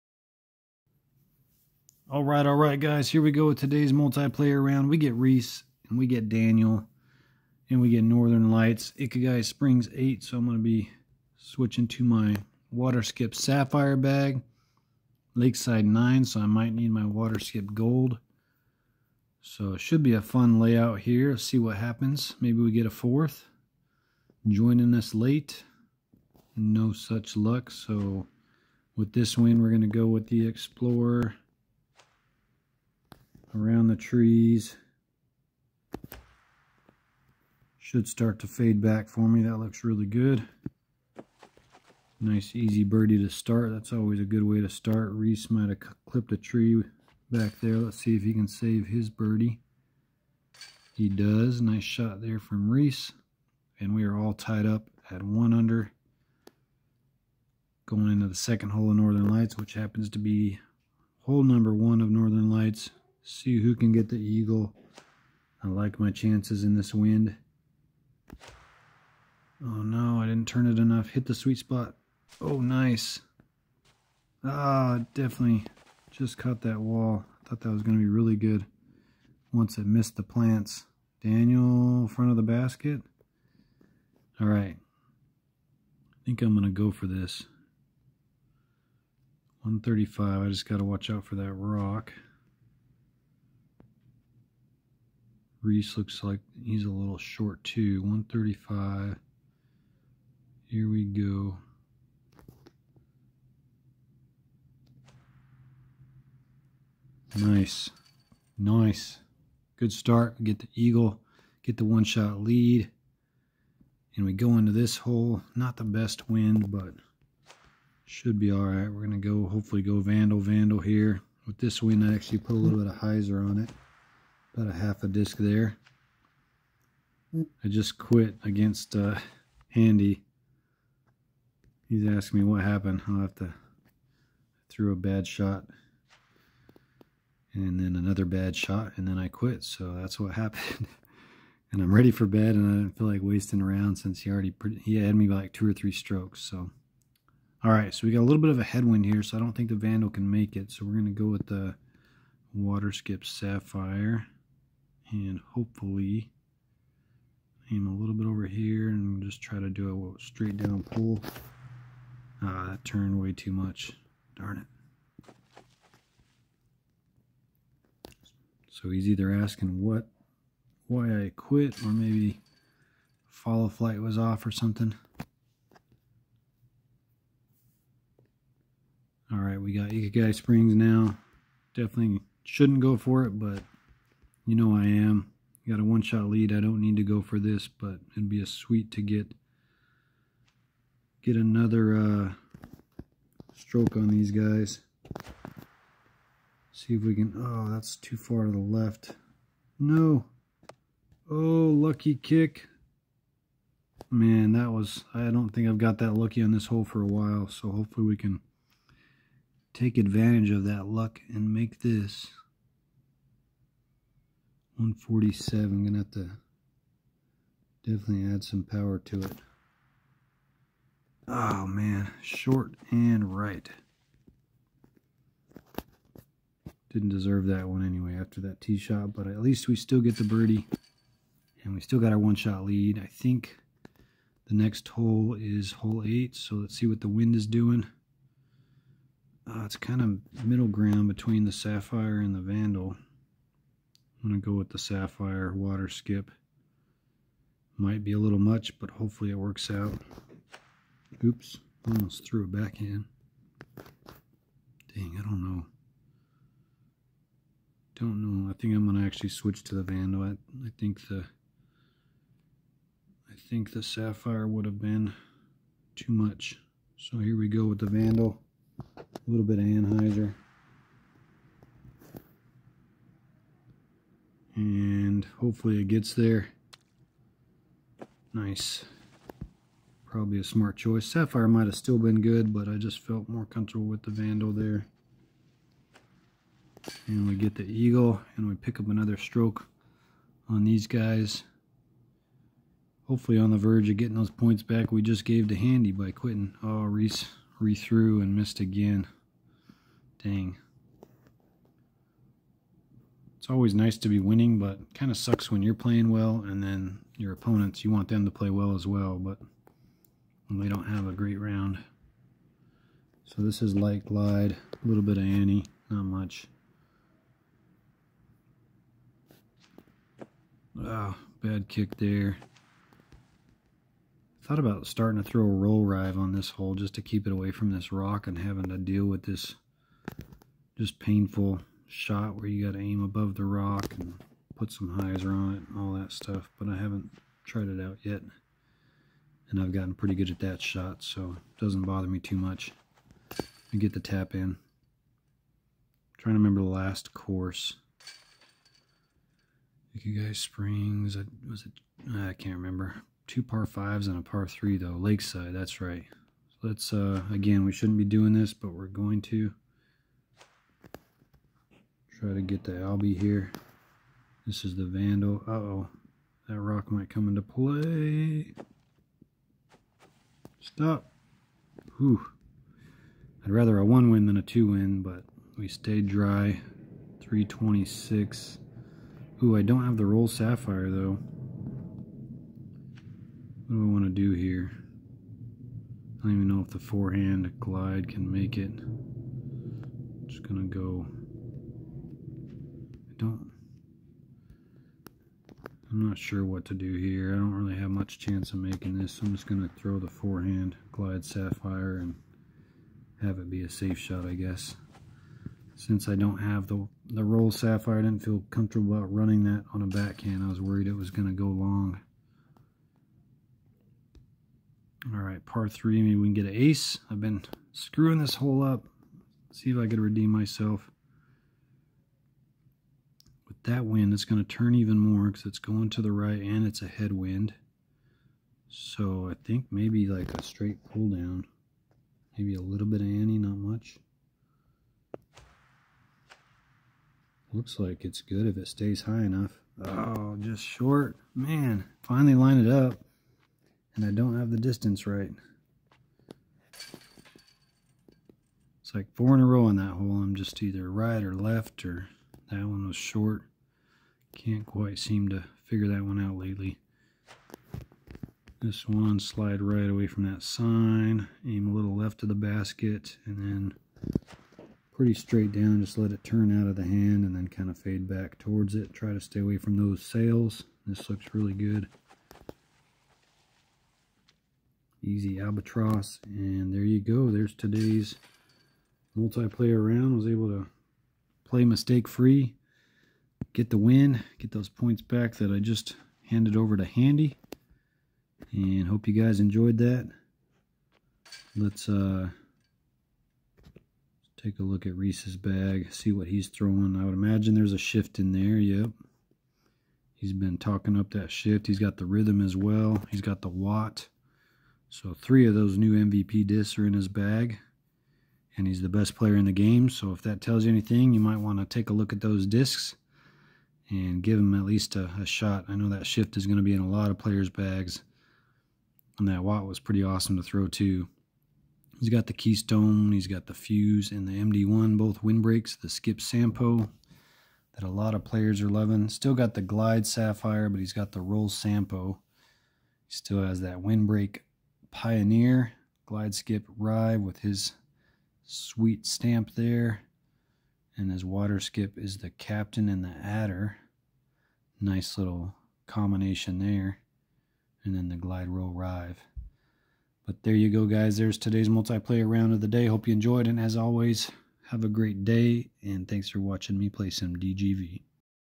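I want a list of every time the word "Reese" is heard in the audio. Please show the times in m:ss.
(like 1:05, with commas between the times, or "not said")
0:05, 0:45, 0:52, 1:35, 4:56, 8:14.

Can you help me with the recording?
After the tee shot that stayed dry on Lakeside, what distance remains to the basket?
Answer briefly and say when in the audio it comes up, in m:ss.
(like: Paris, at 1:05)
326, at 6:17.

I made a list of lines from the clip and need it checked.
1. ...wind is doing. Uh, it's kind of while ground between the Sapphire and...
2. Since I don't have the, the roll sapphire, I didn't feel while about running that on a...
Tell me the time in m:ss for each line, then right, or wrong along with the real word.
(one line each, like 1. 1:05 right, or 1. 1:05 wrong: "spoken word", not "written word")
1. 3:57 wrong: "middle", not "while"
2. 6:45 wrong: "comfortable", not "while".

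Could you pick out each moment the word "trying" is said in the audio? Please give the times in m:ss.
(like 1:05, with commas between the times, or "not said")
5:46.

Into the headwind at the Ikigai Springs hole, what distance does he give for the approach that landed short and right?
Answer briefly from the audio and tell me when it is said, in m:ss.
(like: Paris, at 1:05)
147, at 3:34.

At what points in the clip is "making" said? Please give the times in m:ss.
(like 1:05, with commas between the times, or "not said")
6:38.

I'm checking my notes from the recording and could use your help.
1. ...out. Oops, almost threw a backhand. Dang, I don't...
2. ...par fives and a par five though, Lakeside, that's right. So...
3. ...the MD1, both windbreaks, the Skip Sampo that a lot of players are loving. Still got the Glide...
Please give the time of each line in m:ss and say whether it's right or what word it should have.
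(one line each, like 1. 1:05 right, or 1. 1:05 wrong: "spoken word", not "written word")
1. 4:09 right
2. 5:53 wrong: "three", not "five"
3. 8:44 right.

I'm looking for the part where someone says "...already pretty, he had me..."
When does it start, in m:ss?
2:24.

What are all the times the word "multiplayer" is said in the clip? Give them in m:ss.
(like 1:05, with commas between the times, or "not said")
0:03, 7:59, 9:11.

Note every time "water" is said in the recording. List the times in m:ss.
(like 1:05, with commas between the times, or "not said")
0:12, 0:17, 2:32, 4:05, 9:01.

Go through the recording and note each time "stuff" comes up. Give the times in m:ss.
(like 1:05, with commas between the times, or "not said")
5:36.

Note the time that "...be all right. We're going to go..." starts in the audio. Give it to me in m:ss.
1:58.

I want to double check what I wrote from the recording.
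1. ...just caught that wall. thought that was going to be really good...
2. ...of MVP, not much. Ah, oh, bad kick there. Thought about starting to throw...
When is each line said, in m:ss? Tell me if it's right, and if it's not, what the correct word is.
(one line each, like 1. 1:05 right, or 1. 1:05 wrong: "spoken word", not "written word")
1. 1:16 right
2. 5:15 wrong: "Annie", not "MVP".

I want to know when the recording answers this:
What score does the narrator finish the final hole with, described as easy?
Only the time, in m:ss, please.
7:55.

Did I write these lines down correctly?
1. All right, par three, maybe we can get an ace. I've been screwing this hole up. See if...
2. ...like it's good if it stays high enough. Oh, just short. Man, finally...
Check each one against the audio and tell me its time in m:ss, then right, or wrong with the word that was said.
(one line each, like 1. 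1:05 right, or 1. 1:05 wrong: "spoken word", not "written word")
1. 6:55 right
2. 7:17 right.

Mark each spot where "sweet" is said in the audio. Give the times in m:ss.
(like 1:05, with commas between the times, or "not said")
1:11, 3:08, 8:58.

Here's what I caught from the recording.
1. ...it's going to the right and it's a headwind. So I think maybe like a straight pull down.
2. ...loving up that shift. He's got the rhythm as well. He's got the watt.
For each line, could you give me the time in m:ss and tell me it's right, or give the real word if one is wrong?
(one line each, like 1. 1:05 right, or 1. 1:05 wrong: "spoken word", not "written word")
1. 7:05 right
2. 8:20 wrong: "talking", not "loving".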